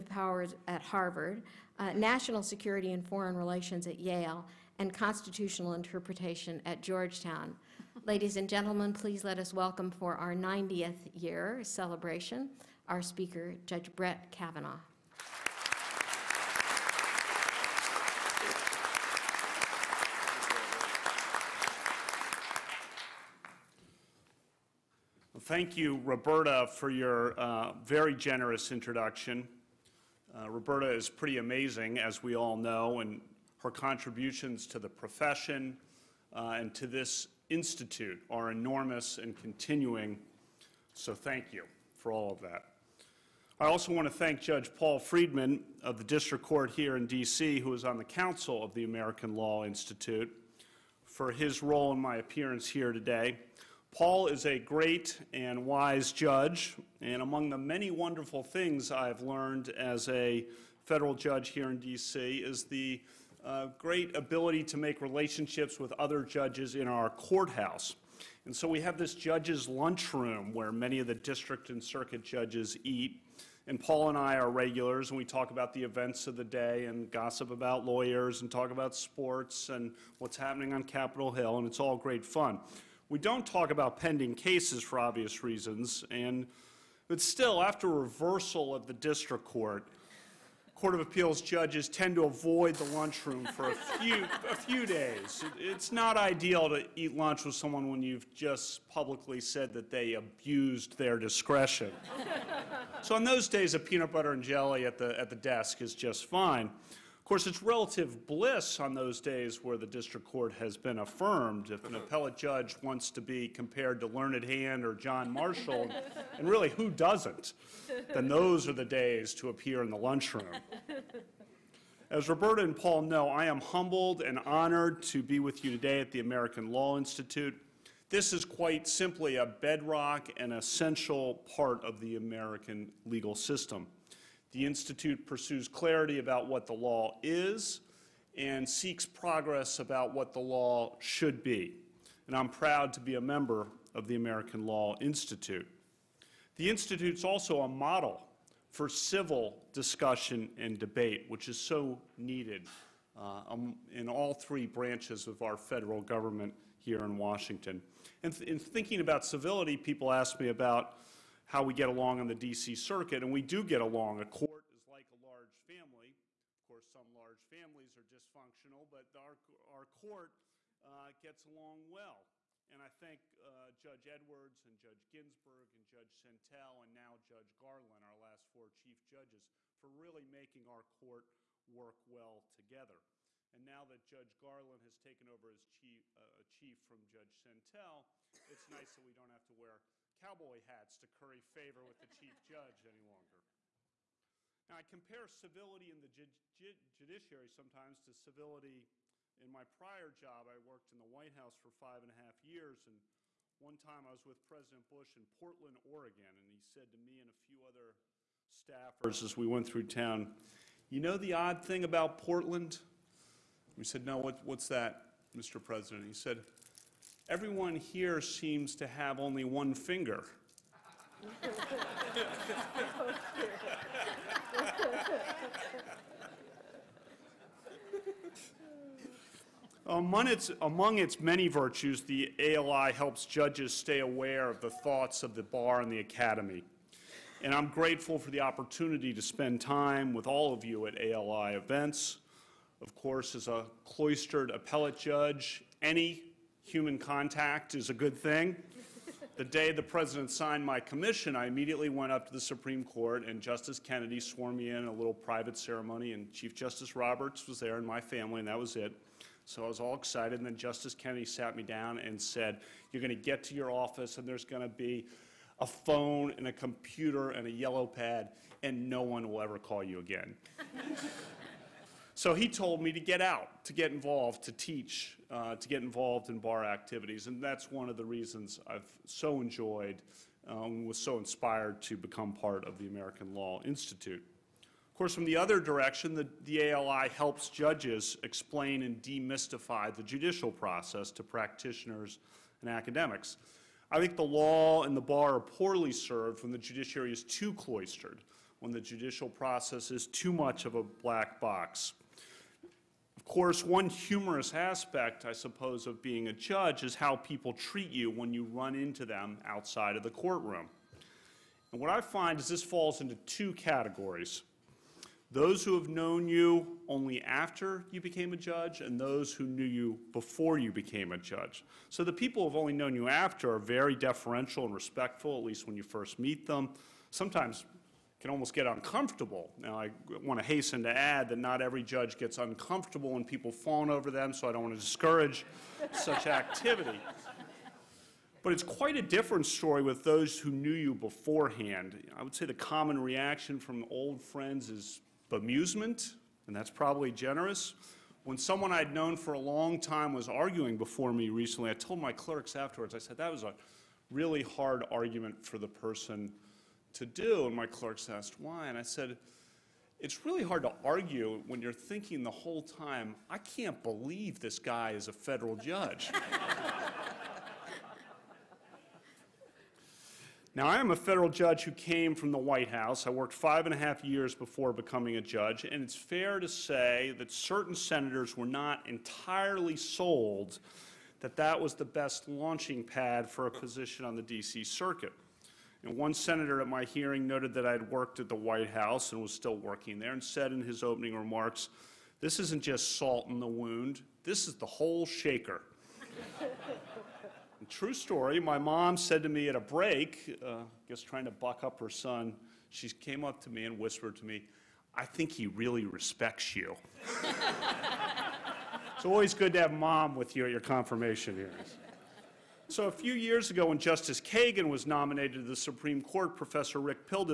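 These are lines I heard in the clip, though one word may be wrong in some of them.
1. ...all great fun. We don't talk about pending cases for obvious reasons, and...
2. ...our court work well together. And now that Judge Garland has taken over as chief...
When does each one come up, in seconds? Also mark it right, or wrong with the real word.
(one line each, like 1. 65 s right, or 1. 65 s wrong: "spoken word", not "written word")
1. 81 s right
2. 180 s right.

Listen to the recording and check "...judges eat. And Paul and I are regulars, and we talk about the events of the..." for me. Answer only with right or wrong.
right.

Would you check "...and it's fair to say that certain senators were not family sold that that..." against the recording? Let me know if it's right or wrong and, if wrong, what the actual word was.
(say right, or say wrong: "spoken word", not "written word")
wrong: "entirely", not "family".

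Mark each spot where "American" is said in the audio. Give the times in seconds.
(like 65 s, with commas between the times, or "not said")
48 s, 126 s, 132 s, 144 s, 282 s.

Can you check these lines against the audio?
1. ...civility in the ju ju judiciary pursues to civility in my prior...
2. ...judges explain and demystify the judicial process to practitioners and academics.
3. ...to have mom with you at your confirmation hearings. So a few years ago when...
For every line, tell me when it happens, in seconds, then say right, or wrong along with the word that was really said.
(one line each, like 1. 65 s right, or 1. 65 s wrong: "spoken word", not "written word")
1. 195 s wrong: "sometimes", not "pursues"
2. 287 s right
3. 409 s right.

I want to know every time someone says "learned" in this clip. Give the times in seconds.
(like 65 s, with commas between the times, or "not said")
59 s, 114 s.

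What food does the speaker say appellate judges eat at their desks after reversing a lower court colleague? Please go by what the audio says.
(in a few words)
peanut butter and jelly.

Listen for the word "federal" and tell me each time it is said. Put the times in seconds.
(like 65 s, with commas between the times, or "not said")
60 s, 155 s, 365 s, 370 s.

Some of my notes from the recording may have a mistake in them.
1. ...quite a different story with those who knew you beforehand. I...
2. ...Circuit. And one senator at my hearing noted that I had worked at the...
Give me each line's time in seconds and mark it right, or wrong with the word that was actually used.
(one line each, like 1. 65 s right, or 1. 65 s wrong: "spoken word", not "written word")
1. 338 s right
2. 384 s right.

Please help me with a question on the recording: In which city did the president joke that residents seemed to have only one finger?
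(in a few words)
Portland, Oregon.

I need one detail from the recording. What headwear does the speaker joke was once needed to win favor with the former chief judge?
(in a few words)
cowboy hats.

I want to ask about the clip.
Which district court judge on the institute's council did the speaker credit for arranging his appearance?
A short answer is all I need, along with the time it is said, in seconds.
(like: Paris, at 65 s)
Paul Friedman, at 44 s.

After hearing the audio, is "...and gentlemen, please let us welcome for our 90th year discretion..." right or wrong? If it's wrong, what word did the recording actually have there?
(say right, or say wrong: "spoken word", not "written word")
wrong: "celebration", not "discretion".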